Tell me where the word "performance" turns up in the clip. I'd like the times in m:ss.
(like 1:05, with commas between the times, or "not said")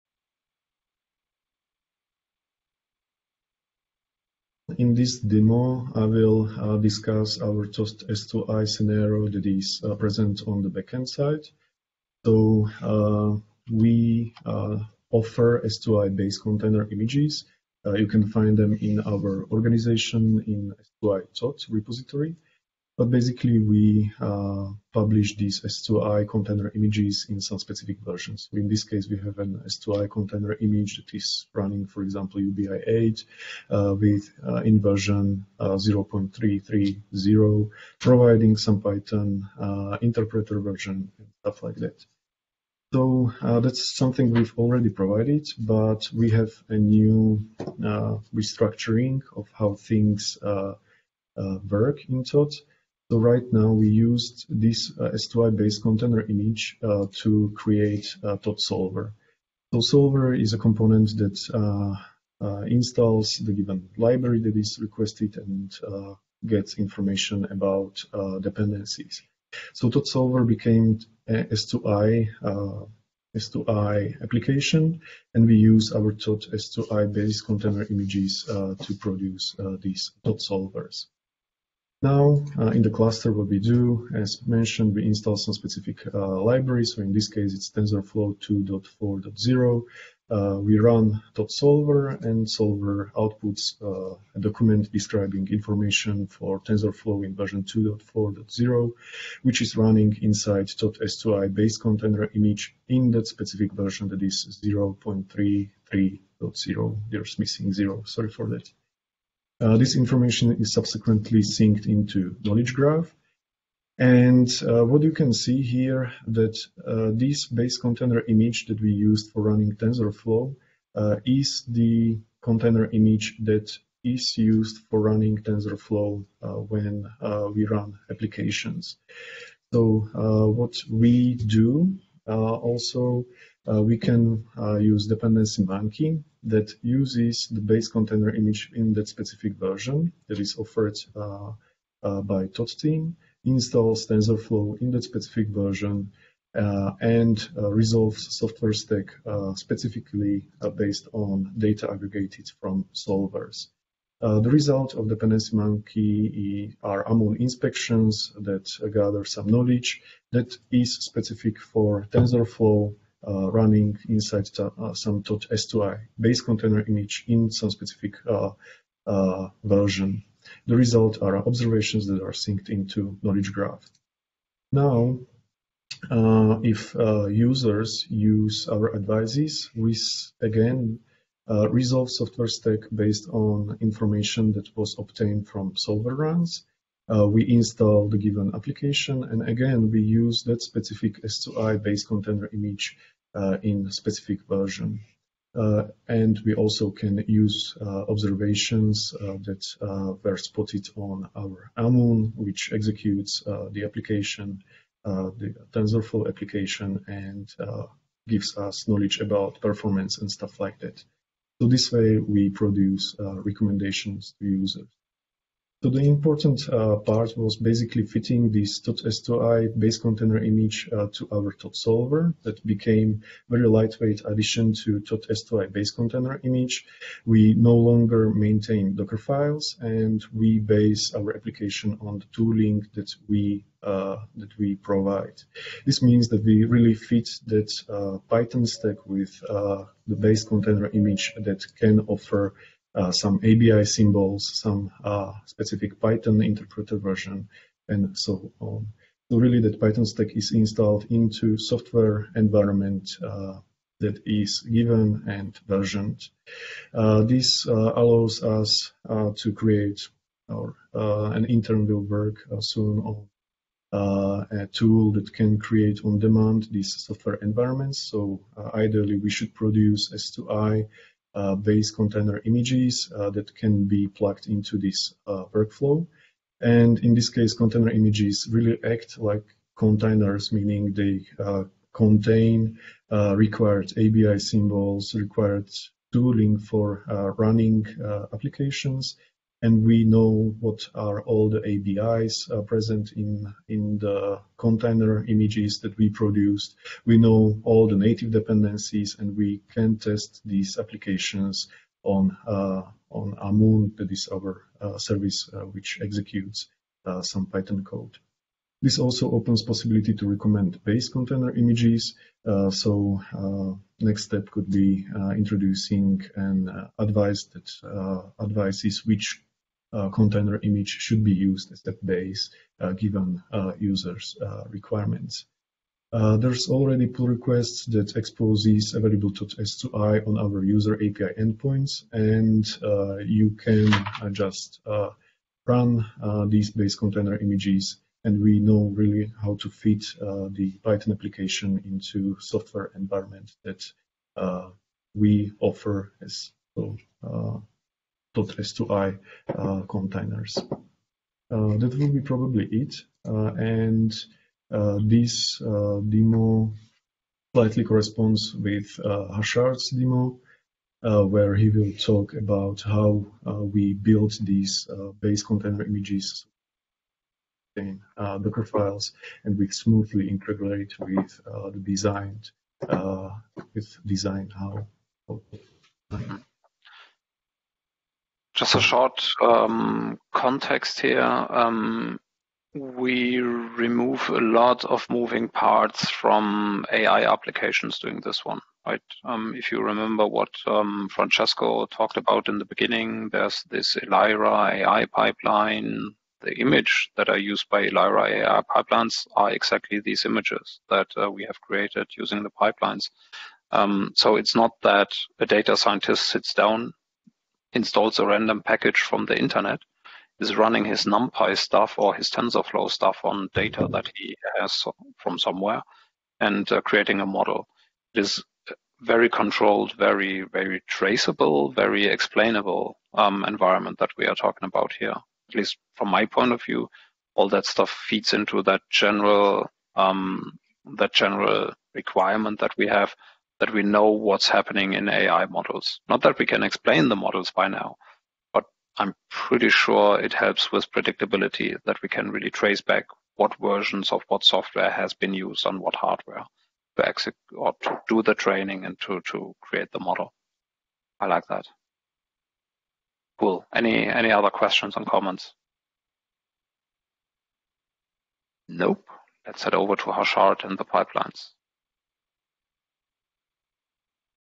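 3:29.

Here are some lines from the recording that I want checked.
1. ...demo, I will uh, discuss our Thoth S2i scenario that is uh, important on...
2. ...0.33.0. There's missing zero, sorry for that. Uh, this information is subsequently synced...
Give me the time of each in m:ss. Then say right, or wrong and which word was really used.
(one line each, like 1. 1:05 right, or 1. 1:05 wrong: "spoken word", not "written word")
1. 0:05 wrong: "present", not "important"
2. 1:44 right.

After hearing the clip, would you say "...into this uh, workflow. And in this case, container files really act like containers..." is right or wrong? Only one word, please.
wrong.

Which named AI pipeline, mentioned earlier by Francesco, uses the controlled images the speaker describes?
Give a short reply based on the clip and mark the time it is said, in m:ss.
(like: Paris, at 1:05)
Lyra AI pipeline, at 6:34.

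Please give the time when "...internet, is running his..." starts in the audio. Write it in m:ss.
6:49.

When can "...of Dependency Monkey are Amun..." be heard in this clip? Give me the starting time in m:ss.
2:34.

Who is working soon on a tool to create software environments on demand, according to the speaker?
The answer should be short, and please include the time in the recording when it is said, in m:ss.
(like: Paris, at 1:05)
an intern, at 4:20.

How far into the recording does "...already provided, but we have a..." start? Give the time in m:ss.
0:44.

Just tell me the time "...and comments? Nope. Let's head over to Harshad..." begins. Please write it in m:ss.
7:34.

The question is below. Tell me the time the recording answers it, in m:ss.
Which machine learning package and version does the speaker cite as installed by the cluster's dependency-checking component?
1:27.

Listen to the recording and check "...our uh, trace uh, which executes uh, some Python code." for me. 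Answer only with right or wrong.
wrong.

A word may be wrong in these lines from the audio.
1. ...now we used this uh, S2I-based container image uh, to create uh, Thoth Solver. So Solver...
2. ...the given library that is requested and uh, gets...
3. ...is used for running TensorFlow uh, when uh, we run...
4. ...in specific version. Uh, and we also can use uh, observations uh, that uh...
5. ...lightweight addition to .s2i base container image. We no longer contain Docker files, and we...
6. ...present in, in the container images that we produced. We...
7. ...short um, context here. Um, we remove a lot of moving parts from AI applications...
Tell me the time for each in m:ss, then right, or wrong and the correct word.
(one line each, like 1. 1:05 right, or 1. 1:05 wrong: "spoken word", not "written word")
1. 0:53 right
2. 1:03 right
3. 2:04 right
4. 3:13 right
5. 3:43 wrong: "maintain", not "contain"
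6. 4:52 right
7. 6:18 right.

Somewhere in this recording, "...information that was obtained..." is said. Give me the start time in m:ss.
3:03.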